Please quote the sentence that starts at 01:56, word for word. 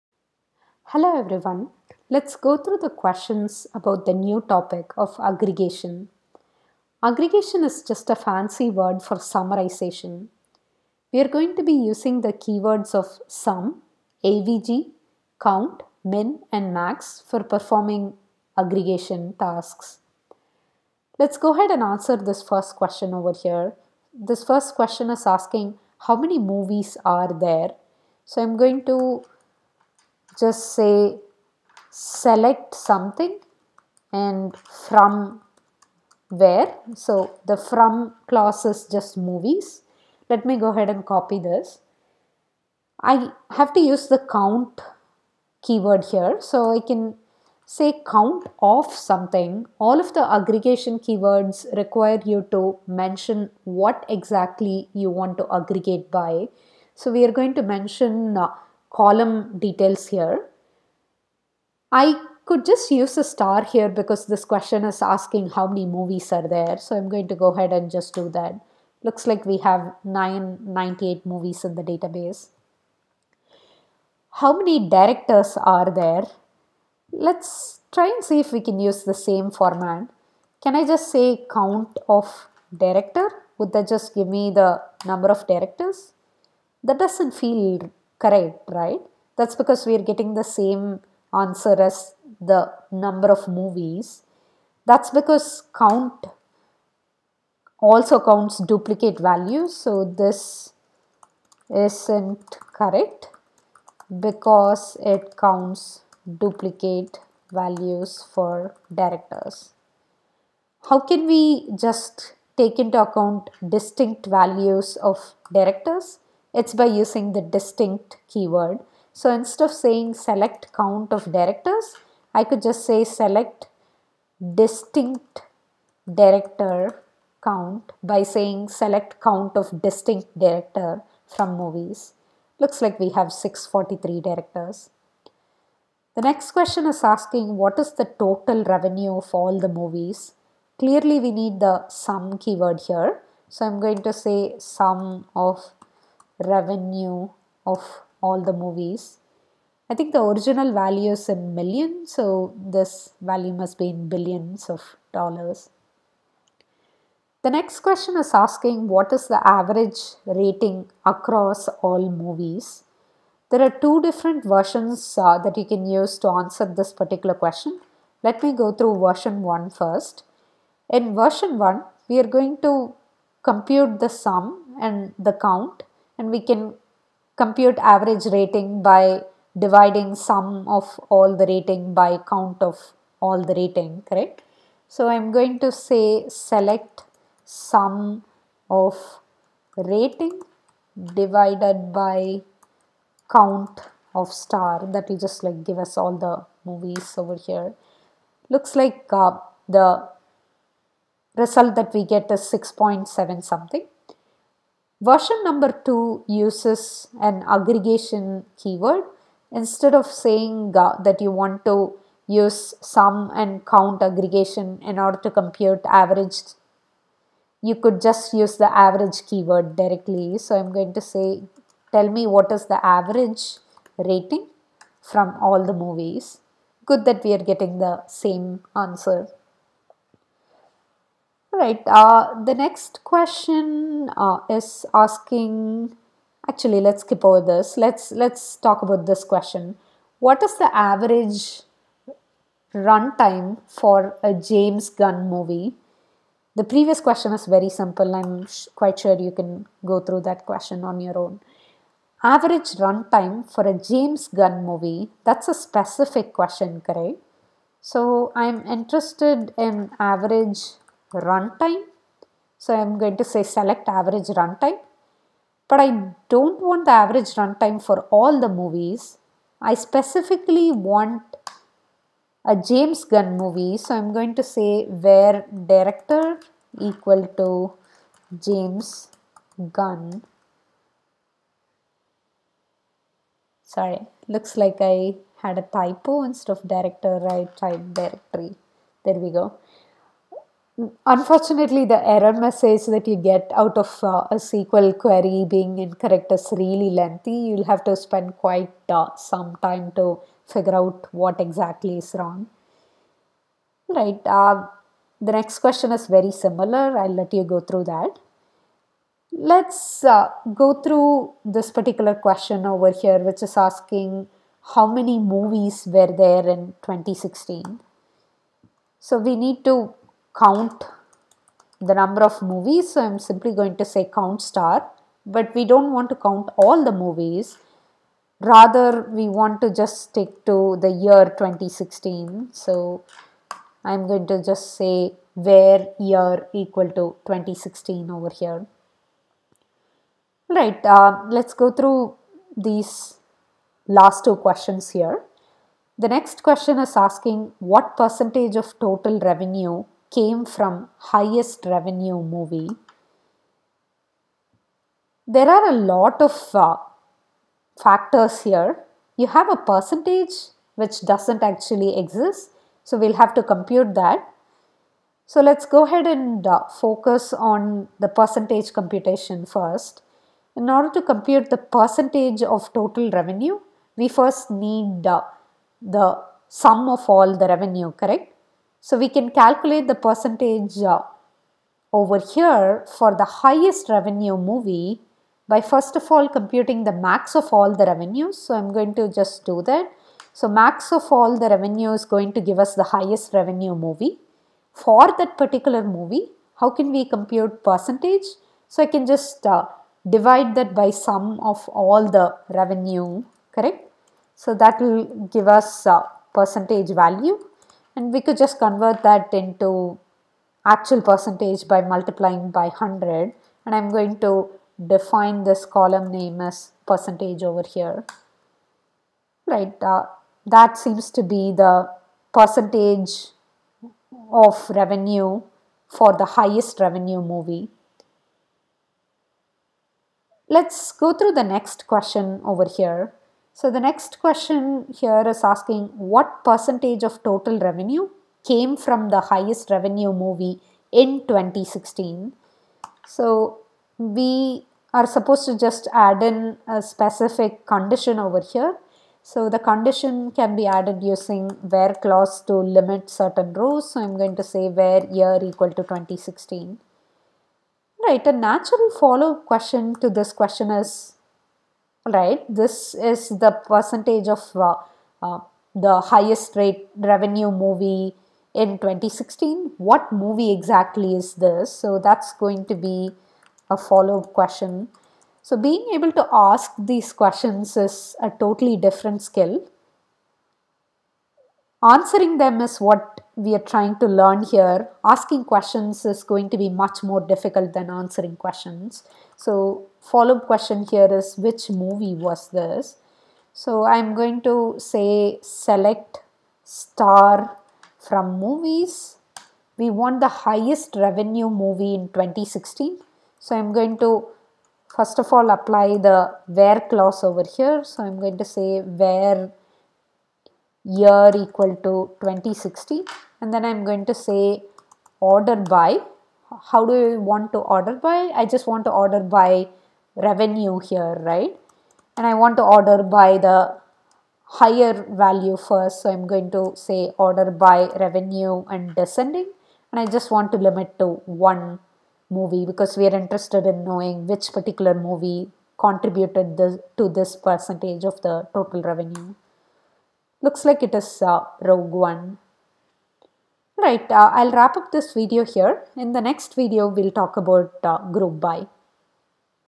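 It's by using the distinct keyword.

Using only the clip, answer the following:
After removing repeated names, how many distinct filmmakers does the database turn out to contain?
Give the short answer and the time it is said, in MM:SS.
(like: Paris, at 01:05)
643, at 02:13.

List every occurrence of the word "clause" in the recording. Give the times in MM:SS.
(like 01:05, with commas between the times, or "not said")
00:38, 07:31, 08:26.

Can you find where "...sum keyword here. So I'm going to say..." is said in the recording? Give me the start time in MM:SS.
02:21.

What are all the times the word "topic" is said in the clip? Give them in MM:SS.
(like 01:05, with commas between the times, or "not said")
00:04.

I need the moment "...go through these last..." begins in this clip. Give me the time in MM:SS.
05:41.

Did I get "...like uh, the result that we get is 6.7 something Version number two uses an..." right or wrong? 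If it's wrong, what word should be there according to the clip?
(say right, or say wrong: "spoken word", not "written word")
right.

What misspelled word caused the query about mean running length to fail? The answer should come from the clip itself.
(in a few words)
directory.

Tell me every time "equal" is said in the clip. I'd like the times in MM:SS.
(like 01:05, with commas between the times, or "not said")
04:36, 05:36, 07:35, 08:31.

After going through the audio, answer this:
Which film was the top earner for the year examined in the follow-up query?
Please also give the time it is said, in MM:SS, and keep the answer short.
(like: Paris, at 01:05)
Rogue One, at 09:01.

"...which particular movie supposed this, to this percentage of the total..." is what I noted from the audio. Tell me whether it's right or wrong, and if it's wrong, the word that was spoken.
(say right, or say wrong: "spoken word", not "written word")
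wrong: "contributed", not "supposed".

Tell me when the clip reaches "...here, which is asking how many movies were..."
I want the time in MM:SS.
05:12.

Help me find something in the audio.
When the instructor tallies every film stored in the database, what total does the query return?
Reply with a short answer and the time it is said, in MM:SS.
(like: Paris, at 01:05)
998, at 01:10.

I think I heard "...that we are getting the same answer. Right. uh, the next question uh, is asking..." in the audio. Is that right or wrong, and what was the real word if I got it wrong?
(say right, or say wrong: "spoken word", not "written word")
right.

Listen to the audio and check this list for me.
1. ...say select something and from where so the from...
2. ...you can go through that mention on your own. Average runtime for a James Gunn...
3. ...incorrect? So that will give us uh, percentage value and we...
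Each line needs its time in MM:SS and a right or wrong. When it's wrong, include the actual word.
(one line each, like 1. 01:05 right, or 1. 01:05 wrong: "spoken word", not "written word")
1. 00:30 right
2. 04:09 wrong: "question", not "mention"
3. 06:43 wrong: "correct", not "incorrect".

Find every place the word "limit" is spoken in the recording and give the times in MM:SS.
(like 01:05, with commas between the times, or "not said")
07:32, 08:50.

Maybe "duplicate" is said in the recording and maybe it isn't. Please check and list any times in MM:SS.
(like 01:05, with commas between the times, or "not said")
01:38, 01:46.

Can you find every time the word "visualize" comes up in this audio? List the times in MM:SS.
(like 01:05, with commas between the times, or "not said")
not said.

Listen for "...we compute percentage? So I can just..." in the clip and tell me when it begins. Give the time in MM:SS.
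06:36.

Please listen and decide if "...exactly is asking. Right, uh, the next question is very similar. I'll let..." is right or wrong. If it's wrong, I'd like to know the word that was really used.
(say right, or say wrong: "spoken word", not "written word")
wrong: "wrong", not "asking".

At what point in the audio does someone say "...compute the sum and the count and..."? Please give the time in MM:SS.
02:53.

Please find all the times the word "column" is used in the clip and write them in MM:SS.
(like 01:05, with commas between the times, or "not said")
00:58, 06:55.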